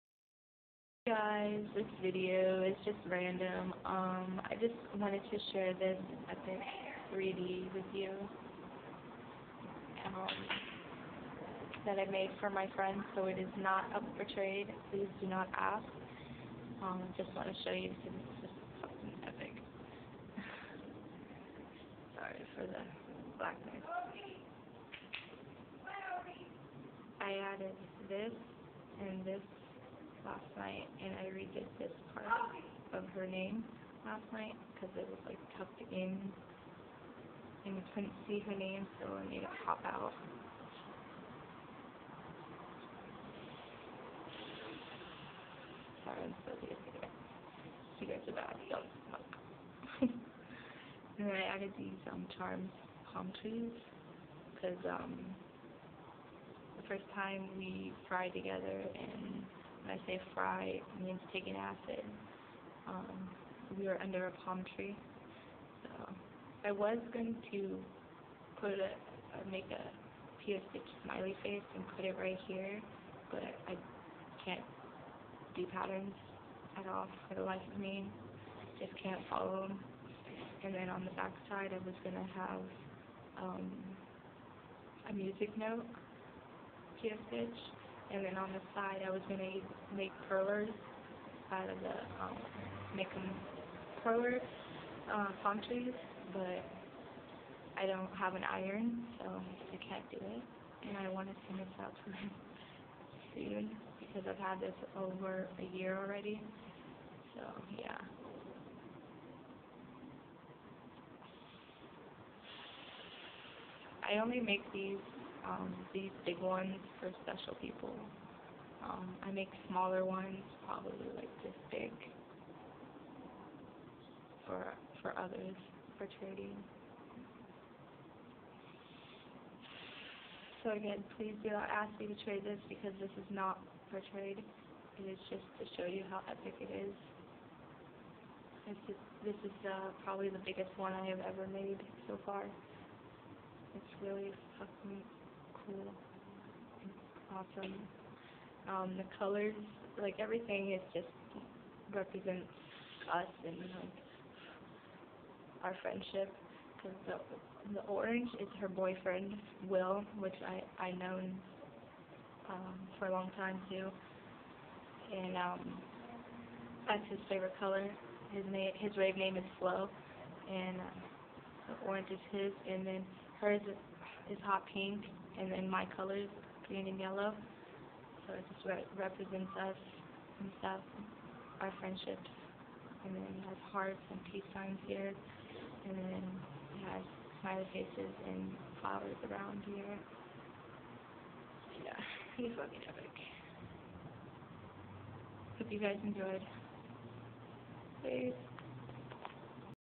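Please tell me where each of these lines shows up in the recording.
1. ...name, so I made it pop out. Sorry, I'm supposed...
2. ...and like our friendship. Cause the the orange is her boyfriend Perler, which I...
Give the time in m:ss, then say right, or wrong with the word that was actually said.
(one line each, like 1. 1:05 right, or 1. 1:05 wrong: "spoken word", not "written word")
1. 0:38 right
2. 2:33 wrong: "Will", not "Perler".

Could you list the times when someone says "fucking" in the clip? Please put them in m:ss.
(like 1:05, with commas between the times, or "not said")
0:18, 2:24, 3:12.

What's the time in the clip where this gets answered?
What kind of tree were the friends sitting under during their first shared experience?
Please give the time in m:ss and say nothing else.
1:04.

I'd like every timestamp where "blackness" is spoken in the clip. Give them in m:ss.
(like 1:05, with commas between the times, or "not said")
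0:23.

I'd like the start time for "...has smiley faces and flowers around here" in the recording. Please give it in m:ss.
3:06.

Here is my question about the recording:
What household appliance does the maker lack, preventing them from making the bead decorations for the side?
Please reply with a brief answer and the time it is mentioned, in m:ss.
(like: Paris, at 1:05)
an iron, at 1:38.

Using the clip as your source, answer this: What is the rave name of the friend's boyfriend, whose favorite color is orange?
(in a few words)
Flo.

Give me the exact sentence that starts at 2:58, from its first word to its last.
So it just re represents us and stuff, our friendships.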